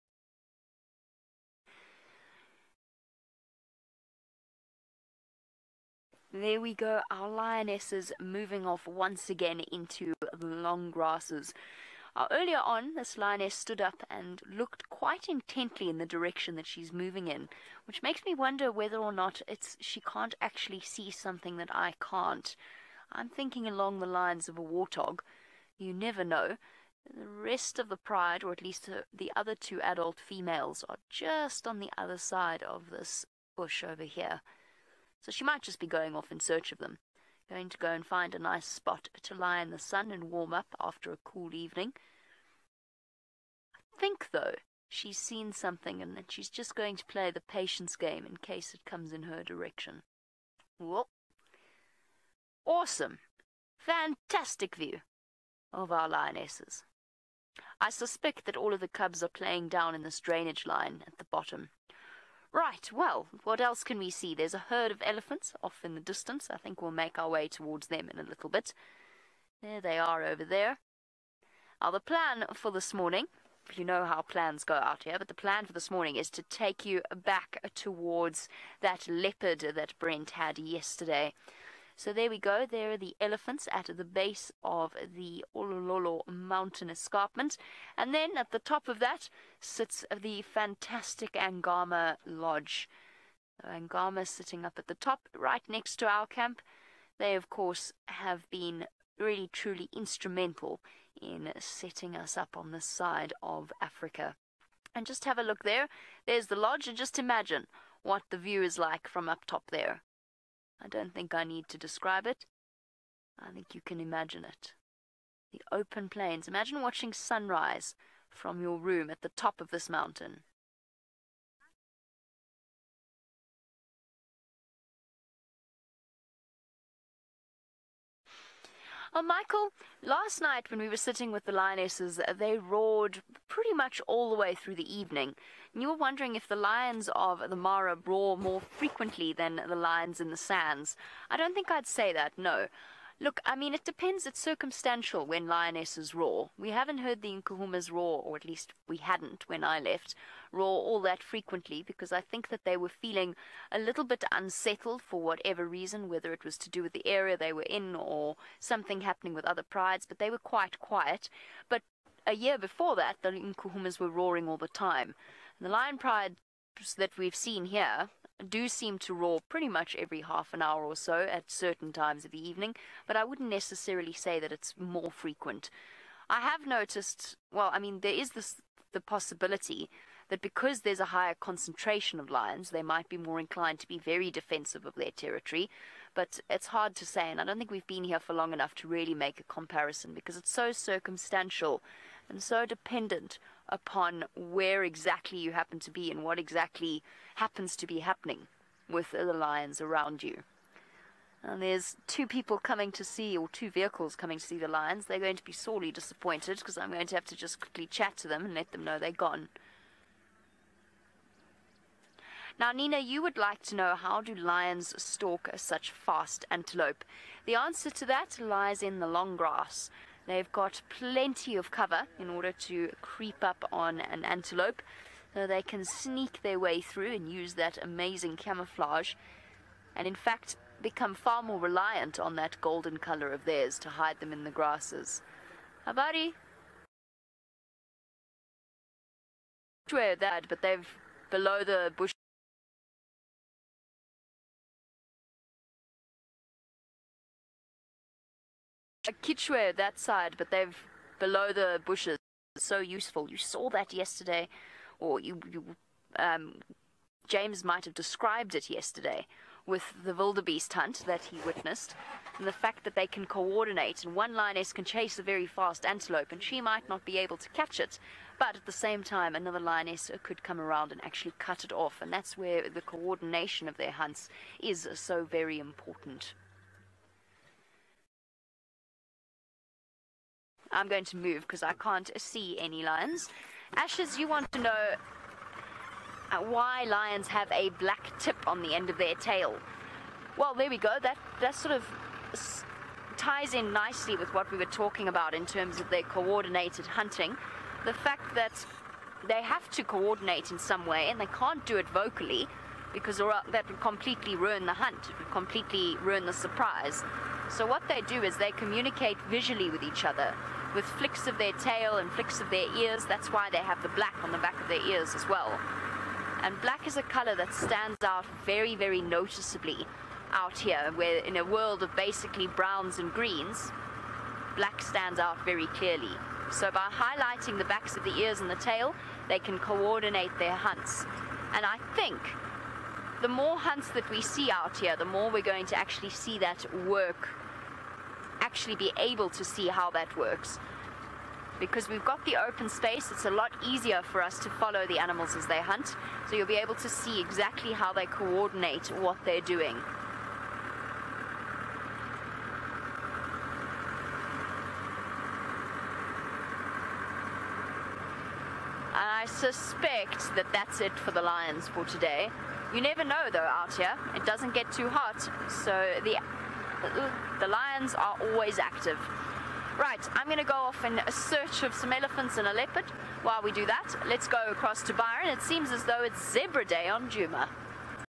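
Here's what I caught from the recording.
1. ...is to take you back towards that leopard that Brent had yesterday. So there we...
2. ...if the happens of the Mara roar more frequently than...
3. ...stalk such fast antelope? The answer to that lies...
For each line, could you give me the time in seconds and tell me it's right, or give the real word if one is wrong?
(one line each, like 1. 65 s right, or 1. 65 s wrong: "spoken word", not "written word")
1. 76 s right
2. 136 s wrong: "lions", not "happens"
3. 215 s right.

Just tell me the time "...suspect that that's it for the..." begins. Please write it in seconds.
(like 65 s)
359 s.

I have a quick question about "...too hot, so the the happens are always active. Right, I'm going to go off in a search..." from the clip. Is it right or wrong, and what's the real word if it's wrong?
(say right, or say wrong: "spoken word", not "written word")
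wrong: "lions", not "happens".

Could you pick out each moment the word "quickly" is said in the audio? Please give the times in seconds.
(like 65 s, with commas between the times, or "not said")
207 s.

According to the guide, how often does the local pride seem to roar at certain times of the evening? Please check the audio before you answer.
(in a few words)
Every half an hour.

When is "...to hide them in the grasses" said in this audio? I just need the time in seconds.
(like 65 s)
233 s.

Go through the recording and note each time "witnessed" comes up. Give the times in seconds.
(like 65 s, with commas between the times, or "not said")
261 s.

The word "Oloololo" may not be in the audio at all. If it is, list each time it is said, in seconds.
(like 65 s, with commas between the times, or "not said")
85 s.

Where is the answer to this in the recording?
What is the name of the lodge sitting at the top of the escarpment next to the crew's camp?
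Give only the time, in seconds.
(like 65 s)
91 s.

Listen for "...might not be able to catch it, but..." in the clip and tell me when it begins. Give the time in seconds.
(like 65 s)
266 s.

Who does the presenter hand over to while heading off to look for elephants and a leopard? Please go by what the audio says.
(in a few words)
Byron.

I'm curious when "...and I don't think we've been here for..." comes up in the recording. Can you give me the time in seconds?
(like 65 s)
187 s.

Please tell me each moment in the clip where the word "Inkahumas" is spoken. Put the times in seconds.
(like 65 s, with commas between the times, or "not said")
147 s, 163 s.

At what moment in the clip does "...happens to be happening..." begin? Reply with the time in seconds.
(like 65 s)
197 s.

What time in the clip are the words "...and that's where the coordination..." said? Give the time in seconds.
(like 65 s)
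272 s.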